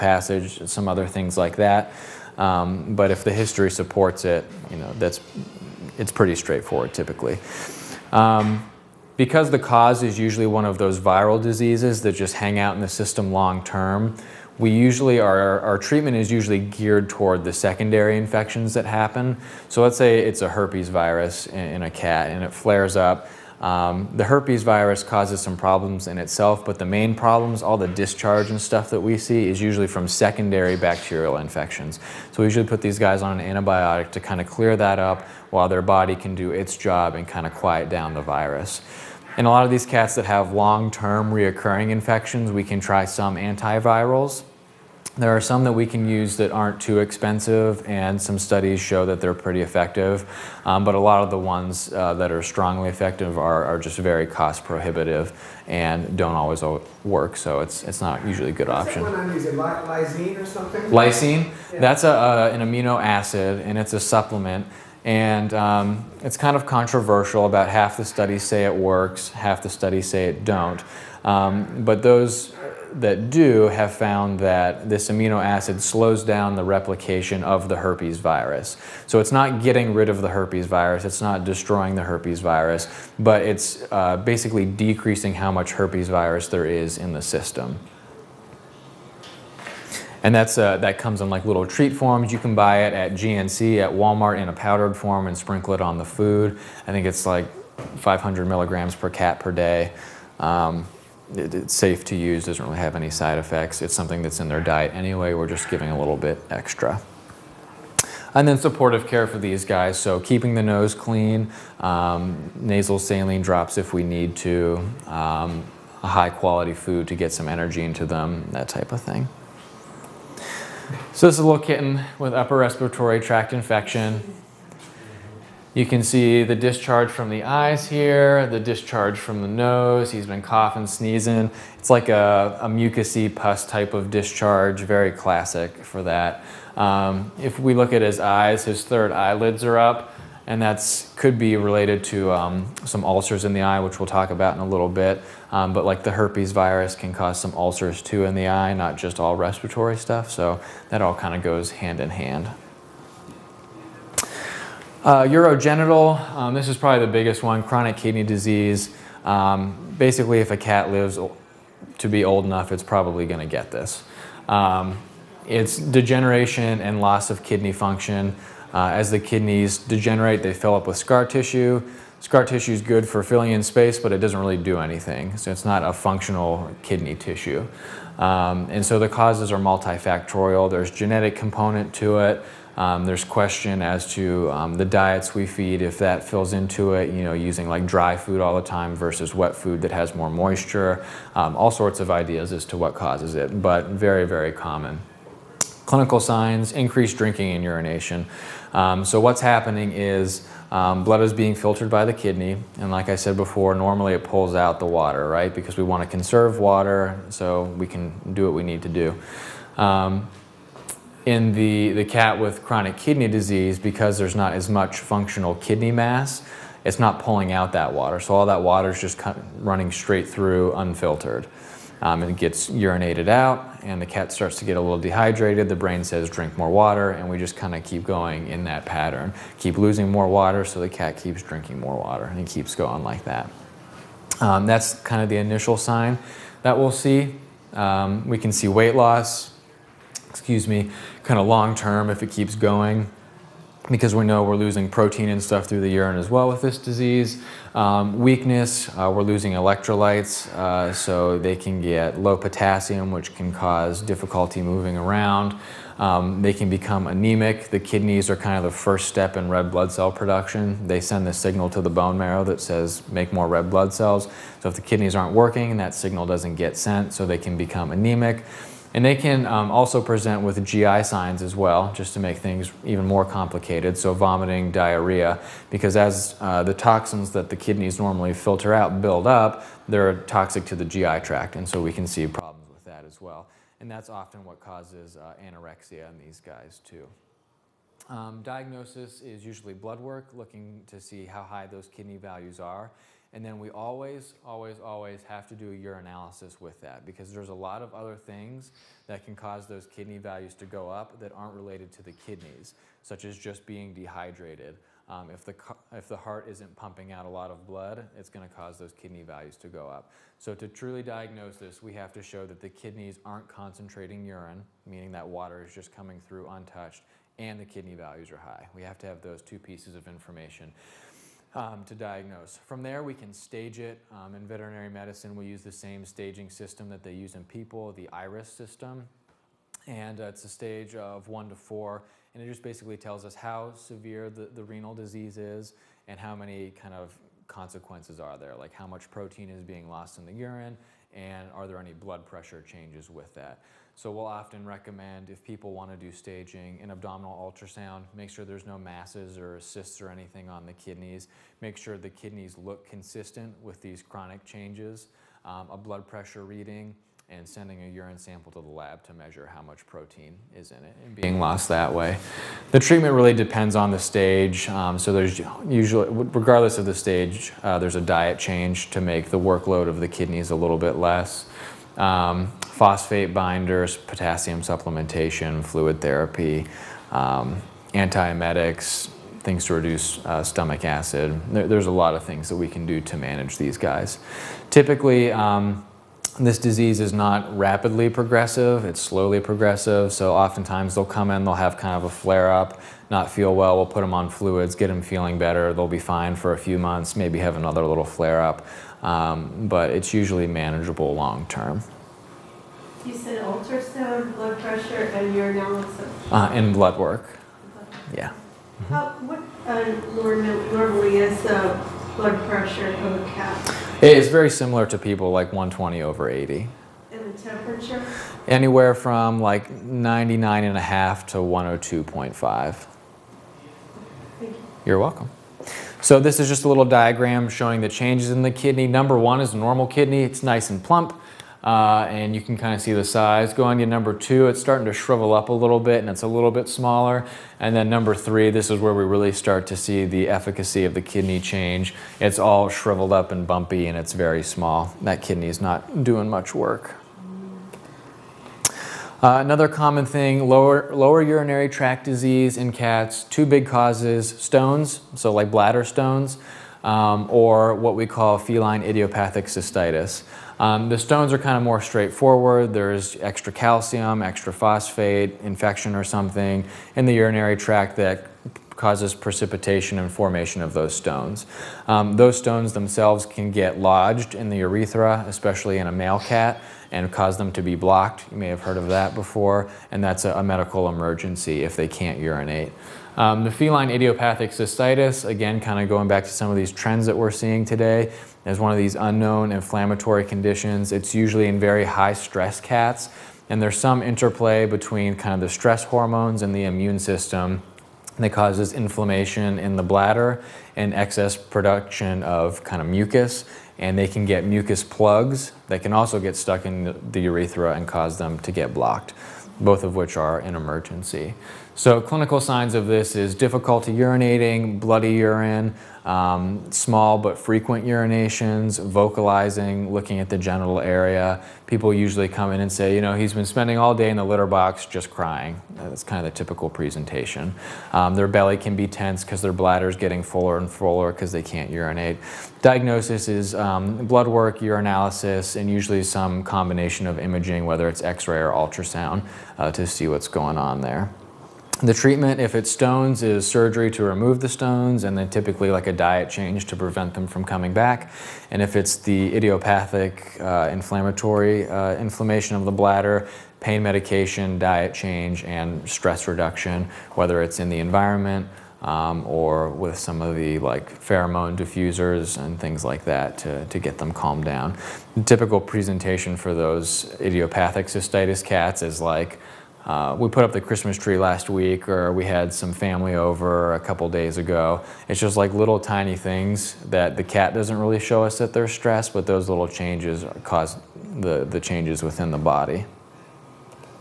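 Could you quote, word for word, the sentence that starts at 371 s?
Um, phosphate binders, potassium supplementation, fluid therapy, um, antiemetics, things to reduce uh, stomach acid.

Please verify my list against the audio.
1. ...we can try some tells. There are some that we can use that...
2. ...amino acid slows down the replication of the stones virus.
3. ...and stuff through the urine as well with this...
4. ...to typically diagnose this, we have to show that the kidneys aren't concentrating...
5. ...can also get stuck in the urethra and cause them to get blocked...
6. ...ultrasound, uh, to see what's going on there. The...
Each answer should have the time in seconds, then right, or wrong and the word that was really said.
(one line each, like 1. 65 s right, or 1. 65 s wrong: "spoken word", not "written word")
1. 42 s wrong: "antivirals", not "tells"
2. 75 s wrong: "herpes", not "stones"
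3. 245 s right
4. 310 s wrong: "truly", not "typically"
5. 505 s right
6. 538 s right.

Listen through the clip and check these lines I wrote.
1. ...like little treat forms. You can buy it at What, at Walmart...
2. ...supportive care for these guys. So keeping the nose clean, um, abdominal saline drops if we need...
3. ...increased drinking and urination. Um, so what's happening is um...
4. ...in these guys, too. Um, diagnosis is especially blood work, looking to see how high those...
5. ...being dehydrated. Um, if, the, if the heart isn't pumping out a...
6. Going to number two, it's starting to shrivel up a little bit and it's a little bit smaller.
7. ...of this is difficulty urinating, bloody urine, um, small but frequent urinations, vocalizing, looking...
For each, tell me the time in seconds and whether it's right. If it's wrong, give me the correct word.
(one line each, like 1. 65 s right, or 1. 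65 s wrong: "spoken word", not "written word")
1. 91 s wrong: "GNC", not "What"
2. 108 s wrong: "nasal", not "abdominal"
3. 196 s right
4. 286 s wrong: "usually", not "especially"
5. 303 s right
6. 433 s right
7. 512 s right.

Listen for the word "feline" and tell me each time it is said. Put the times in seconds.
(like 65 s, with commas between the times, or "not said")
458 s, 483 s.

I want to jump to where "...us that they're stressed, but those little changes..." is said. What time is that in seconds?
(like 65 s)
578 s.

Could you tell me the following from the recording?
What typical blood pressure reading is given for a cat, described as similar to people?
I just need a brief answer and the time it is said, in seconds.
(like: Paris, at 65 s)
120 over 80, at 415 s.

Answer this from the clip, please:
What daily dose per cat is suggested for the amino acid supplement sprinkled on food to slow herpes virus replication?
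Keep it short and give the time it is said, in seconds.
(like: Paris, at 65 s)
500 milligrams, at 97 s.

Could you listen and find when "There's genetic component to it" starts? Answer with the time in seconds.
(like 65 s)
180 s.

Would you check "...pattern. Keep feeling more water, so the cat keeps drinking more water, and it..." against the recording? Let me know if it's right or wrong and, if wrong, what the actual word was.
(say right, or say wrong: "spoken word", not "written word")
wrong: "losing", not "feeling".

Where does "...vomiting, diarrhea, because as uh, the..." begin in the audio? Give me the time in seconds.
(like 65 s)
274 s.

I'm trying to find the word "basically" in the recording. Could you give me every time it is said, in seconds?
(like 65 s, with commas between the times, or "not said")
84 s, 159 s, 332 s.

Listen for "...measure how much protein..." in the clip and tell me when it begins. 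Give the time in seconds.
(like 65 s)
359 s.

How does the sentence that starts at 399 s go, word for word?
Um, but it's usually manageable long term.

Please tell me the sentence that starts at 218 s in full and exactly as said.
So all that water is just running straight through unfiltered.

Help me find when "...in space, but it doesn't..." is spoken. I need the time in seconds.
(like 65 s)
173 s.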